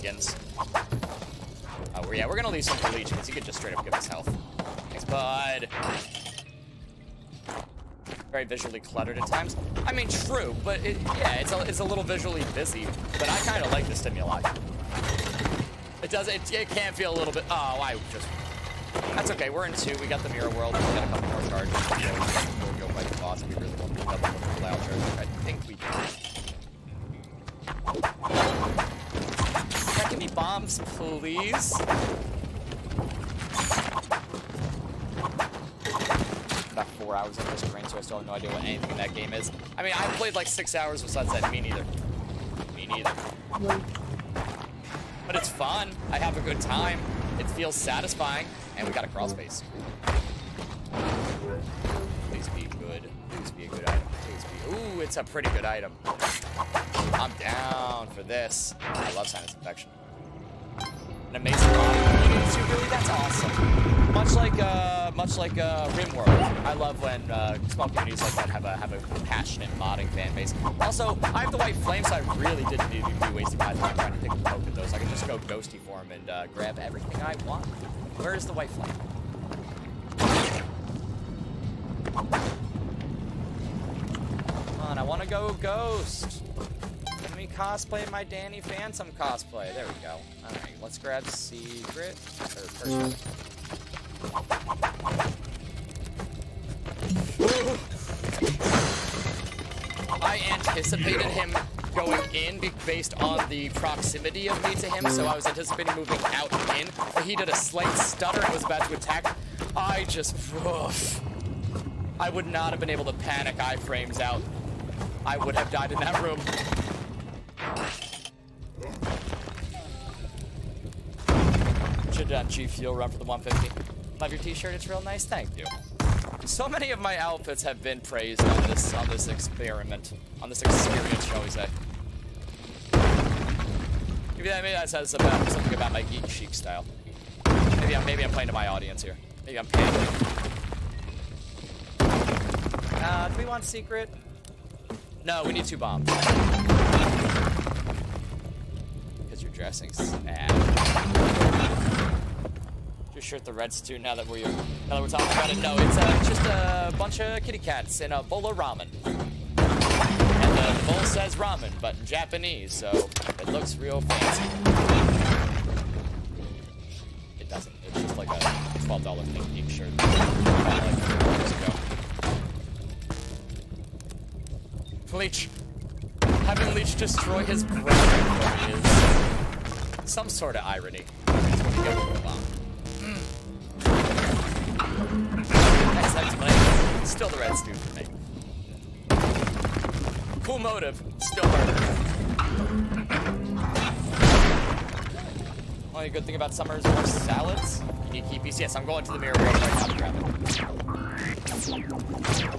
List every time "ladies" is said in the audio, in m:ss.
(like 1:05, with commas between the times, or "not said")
not said.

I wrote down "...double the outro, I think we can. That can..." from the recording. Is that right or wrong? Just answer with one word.
right.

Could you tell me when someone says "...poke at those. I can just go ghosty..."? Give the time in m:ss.
1:14.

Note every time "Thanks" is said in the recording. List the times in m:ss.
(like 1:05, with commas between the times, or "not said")
0:04, 2:05.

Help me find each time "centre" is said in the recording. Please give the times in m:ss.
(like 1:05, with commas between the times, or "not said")
not said.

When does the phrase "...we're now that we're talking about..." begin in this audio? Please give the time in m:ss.
2:34.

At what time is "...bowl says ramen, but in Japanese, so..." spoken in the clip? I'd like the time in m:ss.
2:40.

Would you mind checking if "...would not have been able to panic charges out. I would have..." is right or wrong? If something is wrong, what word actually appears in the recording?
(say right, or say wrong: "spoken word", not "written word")
wrong: "iframes", not "charges".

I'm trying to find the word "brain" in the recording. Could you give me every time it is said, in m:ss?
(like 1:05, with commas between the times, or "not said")
0:37.